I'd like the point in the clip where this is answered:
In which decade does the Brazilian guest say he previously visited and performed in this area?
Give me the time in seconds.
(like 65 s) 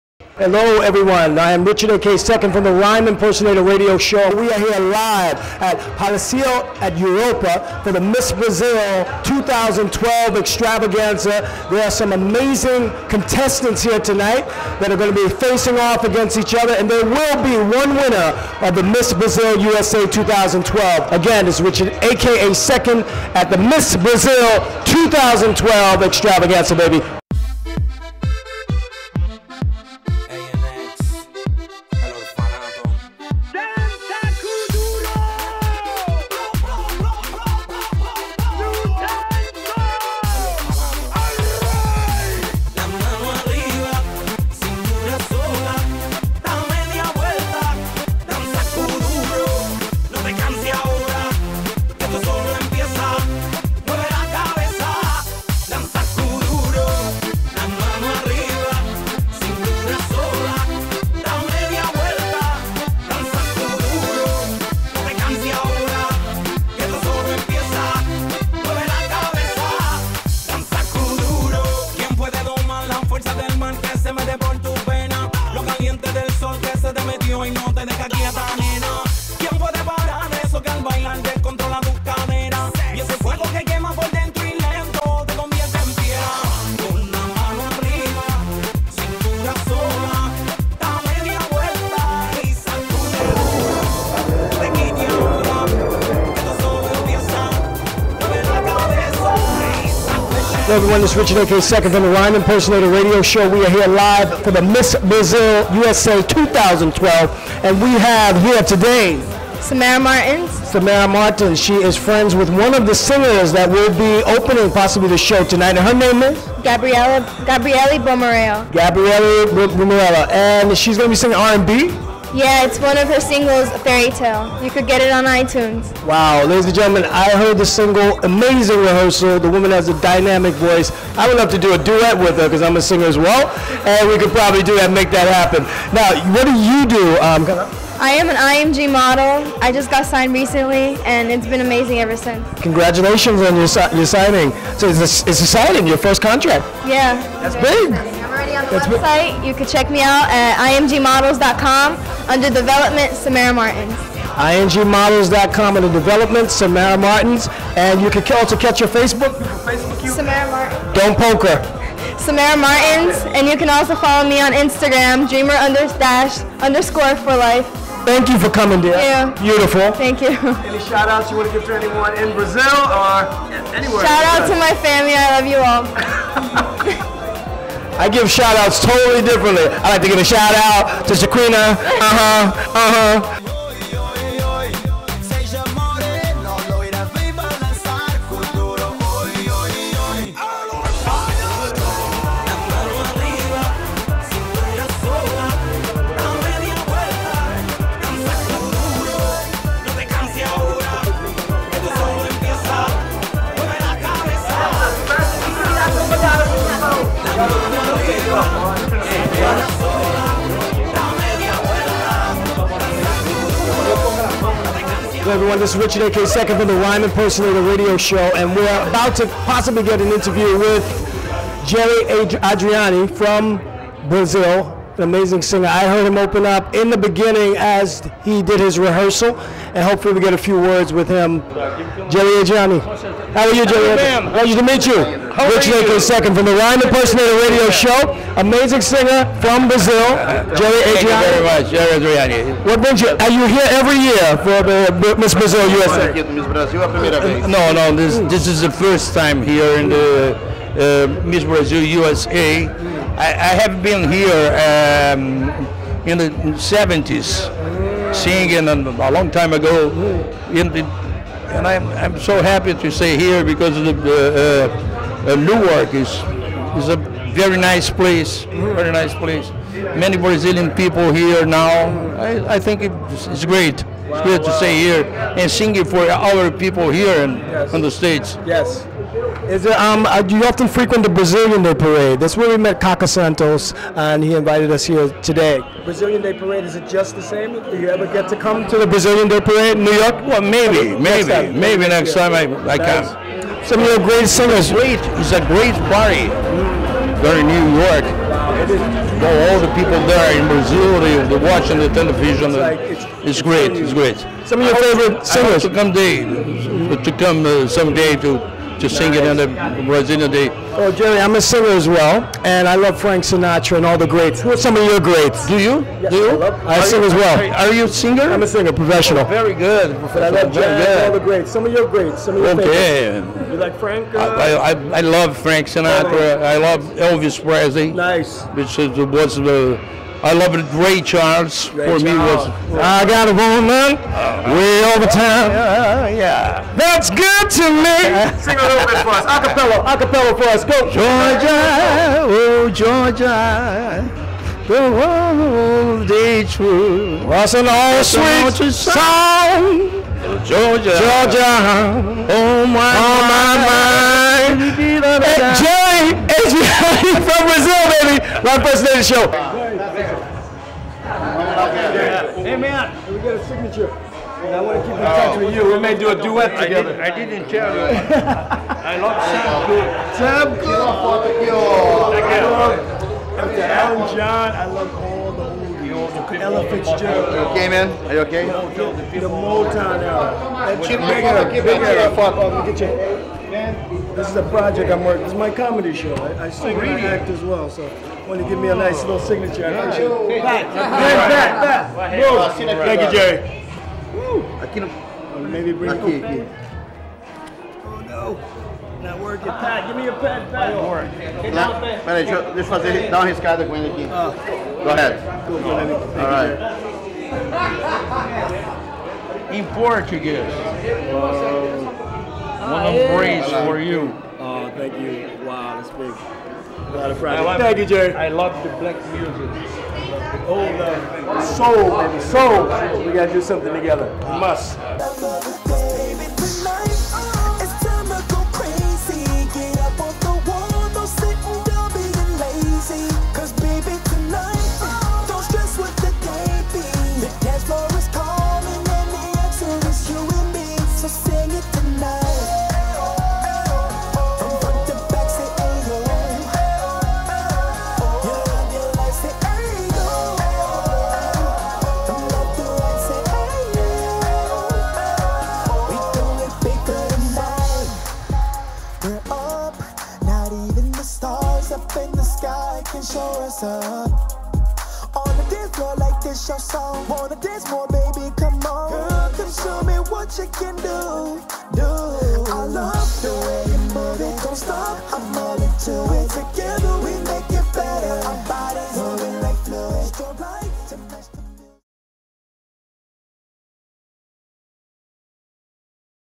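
256 s.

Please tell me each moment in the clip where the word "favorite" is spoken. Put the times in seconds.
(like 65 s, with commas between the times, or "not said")
304 s, 323 s.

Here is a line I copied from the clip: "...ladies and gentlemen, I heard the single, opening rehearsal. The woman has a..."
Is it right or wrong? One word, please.
wrong.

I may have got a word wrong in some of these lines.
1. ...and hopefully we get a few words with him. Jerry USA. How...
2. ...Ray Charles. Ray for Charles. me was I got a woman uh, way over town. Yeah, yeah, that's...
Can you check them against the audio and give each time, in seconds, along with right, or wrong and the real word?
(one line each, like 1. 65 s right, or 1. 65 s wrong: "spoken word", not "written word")
1. 229 s wrong: "Adriani", not "USA"
2. 330 s right.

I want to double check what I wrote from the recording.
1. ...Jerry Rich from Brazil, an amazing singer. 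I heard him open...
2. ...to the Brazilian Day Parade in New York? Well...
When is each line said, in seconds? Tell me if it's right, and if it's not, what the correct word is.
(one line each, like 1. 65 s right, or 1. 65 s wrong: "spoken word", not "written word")
1. 221 s wrong: "Adriani", not "Rich"
2. 288 s right.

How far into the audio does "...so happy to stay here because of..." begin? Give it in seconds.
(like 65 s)
262 s.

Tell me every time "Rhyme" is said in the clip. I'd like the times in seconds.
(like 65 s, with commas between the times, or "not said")
2 s, 102 s, 216 s, 236 s.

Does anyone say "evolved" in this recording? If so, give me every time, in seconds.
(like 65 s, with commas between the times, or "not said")
not said.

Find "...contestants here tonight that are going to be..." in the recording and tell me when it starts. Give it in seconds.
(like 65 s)
13 s.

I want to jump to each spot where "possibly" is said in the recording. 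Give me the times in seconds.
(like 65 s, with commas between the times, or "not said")
114 s, 219 s.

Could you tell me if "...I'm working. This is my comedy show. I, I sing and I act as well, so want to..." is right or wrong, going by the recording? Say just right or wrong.
right.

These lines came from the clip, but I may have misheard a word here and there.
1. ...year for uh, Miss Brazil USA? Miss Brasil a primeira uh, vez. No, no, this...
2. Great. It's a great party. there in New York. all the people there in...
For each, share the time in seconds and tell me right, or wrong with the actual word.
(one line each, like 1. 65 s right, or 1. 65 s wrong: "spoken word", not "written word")
1. 243 s right
2. 294 s right.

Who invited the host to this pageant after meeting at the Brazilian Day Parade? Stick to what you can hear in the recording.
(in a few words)
Caca Santos.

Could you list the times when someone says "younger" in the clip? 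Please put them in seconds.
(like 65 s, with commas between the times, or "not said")
not said.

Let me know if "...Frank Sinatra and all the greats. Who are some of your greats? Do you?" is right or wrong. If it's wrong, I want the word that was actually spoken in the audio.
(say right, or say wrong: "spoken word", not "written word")
right.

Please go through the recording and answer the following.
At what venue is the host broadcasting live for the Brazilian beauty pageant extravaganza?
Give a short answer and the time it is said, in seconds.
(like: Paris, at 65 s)
Palacio at Europa, at 5 s.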